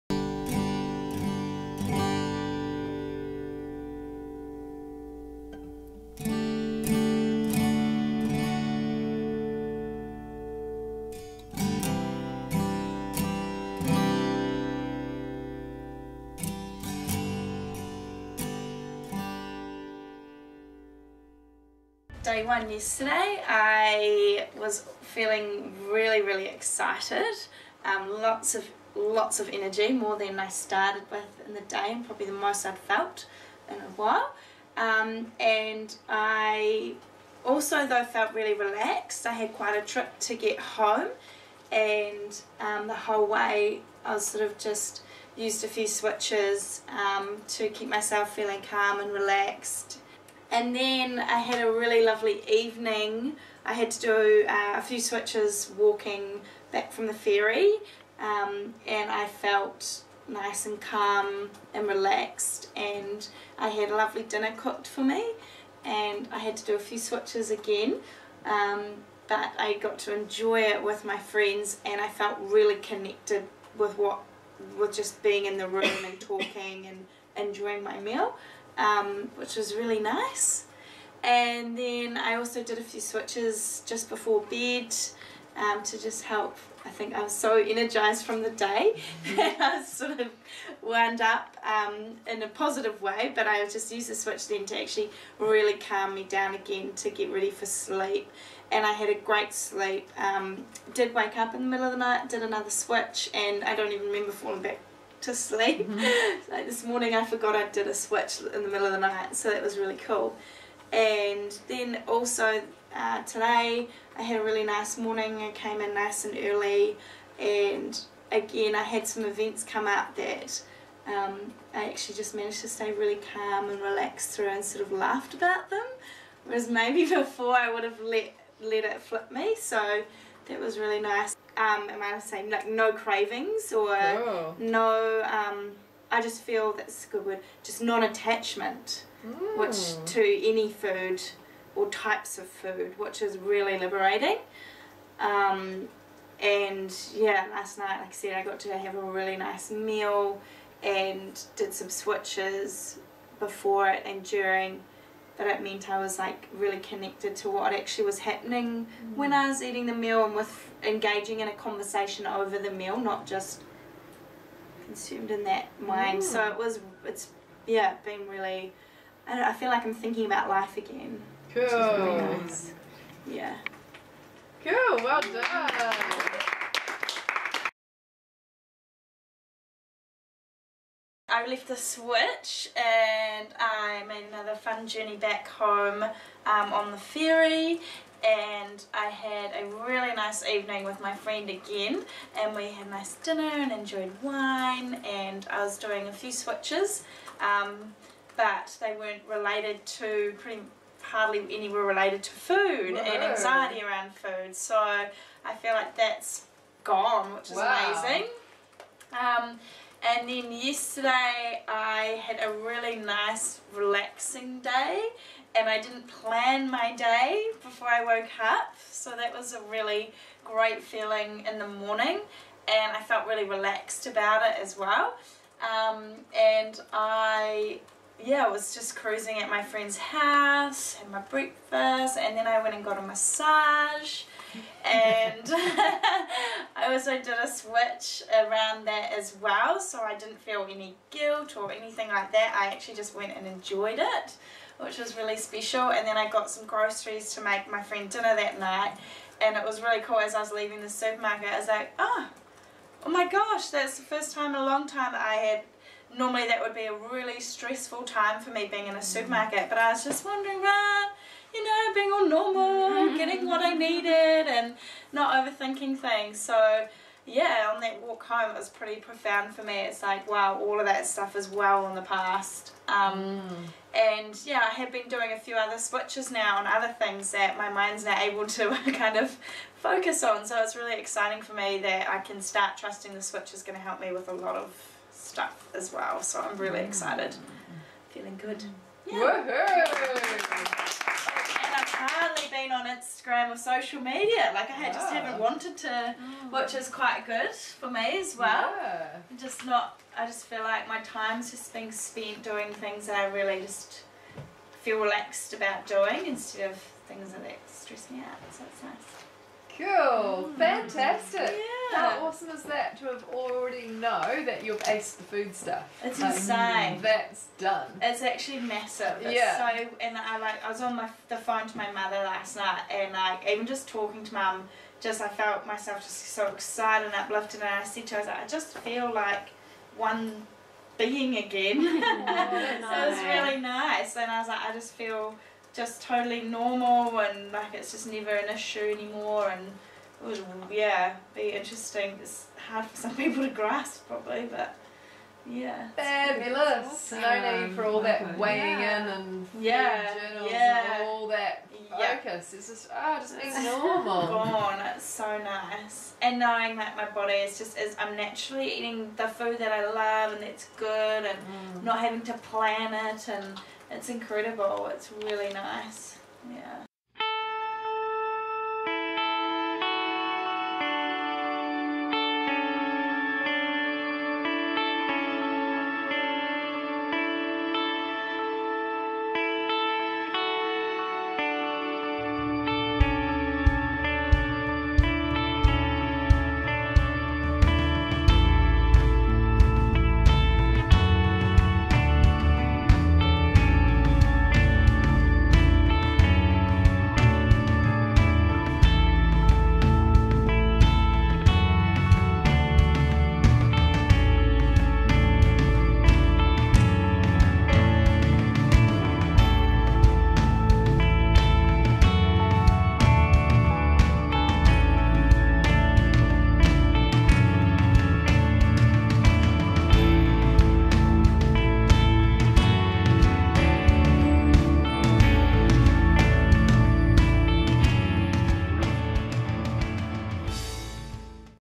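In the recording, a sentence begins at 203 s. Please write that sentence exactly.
and anxiety around food so I feel like that's gone which is wow.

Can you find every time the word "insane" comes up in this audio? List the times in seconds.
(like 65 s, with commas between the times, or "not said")
316 s.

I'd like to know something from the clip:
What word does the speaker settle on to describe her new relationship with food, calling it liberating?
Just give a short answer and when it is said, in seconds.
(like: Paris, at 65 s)
Non-attachment, at 137 s.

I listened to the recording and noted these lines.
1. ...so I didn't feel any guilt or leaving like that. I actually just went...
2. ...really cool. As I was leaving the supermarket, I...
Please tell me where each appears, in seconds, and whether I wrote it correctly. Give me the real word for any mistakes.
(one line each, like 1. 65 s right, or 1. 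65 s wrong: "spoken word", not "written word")
1. 239 s wrong: "anything", not "leaving"
2. 249 s right.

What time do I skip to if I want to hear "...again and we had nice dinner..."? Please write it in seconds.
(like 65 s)
191 s.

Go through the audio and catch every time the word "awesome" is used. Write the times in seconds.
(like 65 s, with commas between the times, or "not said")
312 s, 346 s.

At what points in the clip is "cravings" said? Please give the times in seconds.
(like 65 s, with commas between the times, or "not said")
132 s.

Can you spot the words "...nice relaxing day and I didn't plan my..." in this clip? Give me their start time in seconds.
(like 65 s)
212 s.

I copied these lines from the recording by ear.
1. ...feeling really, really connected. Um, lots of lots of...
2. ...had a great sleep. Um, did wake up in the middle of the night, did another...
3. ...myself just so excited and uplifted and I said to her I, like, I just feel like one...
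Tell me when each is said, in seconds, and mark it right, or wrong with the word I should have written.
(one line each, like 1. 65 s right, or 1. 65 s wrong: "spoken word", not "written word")
1. 25 s wrong: "excited", not "connected"
2. 98 s right
3. 325 s right.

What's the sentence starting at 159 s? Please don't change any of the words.
when I was eating the meal and with engaging in a conversation over the meal, not just consumed in that mind.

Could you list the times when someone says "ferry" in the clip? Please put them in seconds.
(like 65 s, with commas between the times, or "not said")
57 s, 186 s.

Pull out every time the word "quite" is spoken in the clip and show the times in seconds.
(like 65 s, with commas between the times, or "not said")
39 s, 296 s.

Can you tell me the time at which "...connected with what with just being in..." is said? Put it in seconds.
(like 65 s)
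72 s.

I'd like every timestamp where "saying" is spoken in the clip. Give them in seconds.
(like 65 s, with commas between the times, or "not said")
132 s.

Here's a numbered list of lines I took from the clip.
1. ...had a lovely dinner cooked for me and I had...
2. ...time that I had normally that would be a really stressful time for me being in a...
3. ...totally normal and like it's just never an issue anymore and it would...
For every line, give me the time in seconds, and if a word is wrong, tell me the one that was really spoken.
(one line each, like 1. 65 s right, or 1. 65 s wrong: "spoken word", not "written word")
1. 63 s right
2. 254 s right
3. 336 s right.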